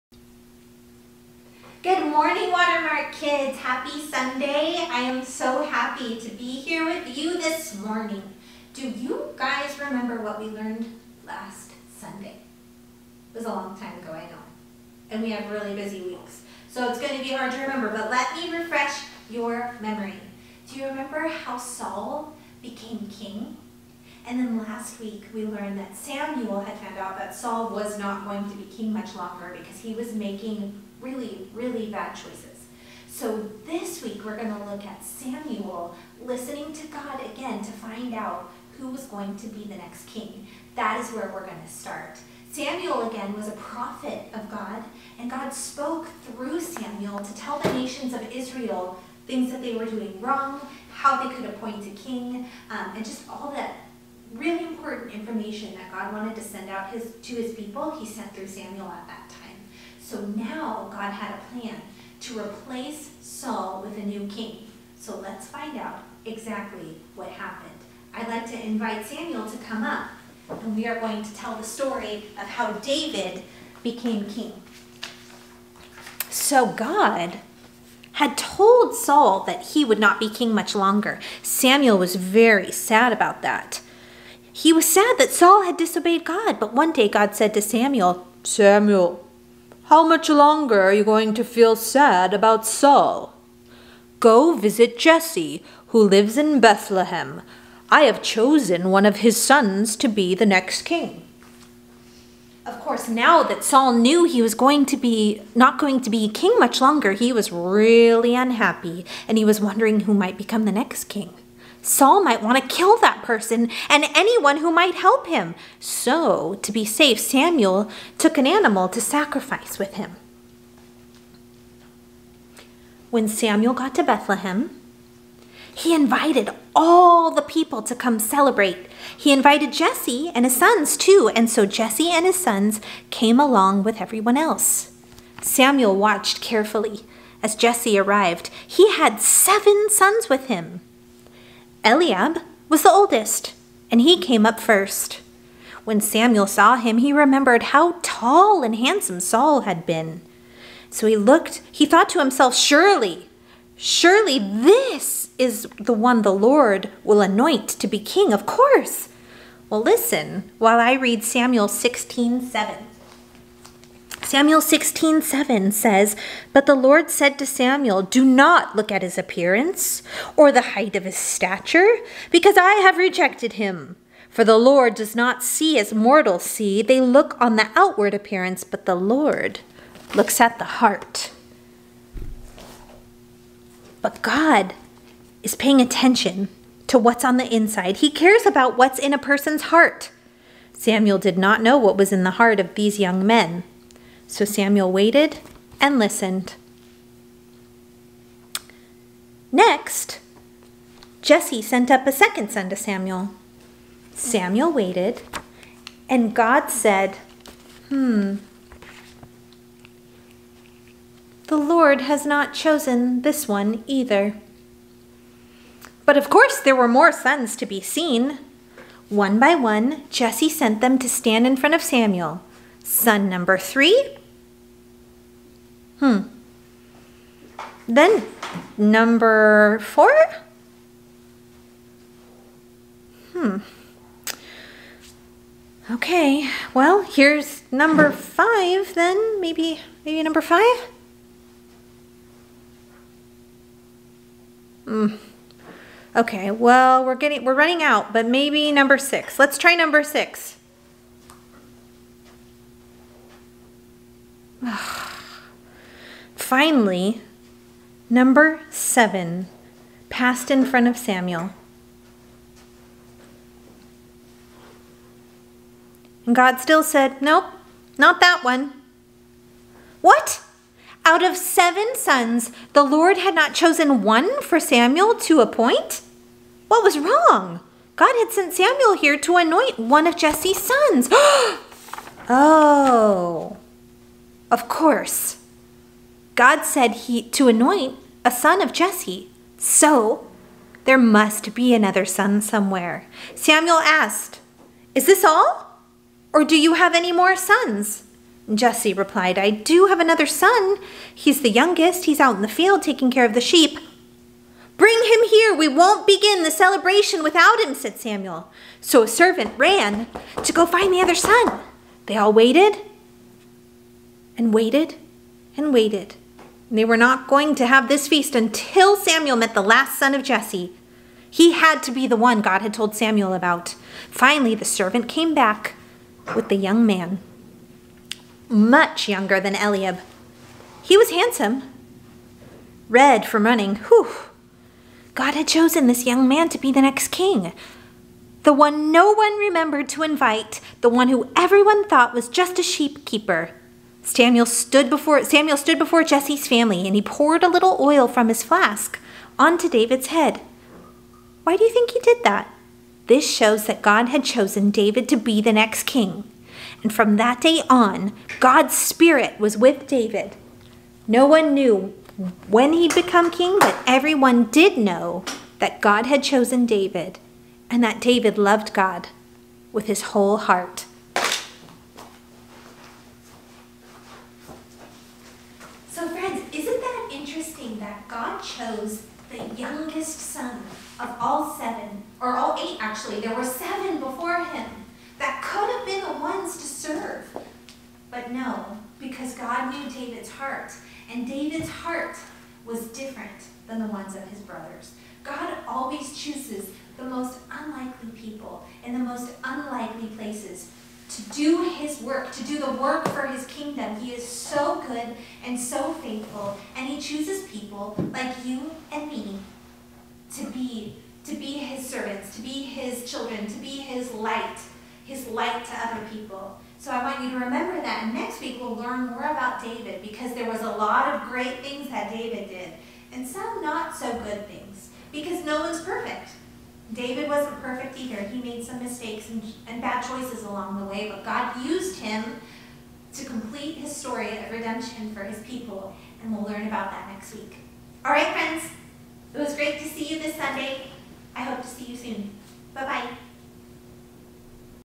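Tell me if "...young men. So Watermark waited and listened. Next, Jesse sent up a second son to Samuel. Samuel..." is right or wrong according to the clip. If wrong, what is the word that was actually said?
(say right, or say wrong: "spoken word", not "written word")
wrong: "Samuel", not "Watermark".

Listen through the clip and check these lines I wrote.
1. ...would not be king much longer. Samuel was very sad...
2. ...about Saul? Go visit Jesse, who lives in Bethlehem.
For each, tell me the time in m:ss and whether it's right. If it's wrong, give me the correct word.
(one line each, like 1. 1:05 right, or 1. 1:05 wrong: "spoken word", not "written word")
1. 1:19 right
2. 1:32 right.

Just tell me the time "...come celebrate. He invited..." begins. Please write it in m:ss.
2:07.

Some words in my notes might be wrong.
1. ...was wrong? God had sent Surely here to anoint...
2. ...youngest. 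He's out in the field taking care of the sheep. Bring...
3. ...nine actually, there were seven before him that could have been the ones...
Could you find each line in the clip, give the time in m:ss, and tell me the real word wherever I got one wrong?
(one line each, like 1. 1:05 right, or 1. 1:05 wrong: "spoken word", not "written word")
1. 4:36 wrong: "Samuel", not "Surely"
2. 5:01 right
3. 6:22 wrong: "eight", not "nine".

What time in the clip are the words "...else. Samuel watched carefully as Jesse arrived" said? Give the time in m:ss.
2:14.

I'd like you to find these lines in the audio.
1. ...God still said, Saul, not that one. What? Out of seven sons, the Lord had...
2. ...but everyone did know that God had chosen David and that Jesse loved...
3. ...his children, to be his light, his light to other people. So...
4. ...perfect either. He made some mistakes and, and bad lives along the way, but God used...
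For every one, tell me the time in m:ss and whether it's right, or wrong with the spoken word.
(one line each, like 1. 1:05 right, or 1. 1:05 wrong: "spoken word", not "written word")
1. 4:26 wrong: "Nope", not "Saul"
2. 6:03 wrong: "David", not "Jesse"
3. 6:52 right
4. 7:07 wrong: "choices", not "lives".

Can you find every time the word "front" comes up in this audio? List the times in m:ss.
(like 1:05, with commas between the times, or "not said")
3:41, 4:20.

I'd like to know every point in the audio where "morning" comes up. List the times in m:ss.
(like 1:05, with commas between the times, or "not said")
0:02, 0:07.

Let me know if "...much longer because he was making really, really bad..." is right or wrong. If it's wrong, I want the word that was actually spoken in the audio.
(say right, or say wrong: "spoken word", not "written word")
right.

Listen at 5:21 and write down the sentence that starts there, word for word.
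He had to be the one God had told Samuel about.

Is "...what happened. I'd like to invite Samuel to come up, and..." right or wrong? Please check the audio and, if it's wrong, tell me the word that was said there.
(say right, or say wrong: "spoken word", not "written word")
right.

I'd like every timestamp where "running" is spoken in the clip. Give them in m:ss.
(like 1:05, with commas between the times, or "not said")
4:07, 5:33.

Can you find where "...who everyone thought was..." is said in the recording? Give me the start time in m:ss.
5:41.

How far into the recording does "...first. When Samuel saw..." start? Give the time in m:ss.
2:24.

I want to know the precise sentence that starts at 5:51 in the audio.
Why do you think he did that?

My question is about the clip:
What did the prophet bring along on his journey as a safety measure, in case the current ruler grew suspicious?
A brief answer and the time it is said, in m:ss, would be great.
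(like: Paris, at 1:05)
An animal to sacrifice, at 1:58.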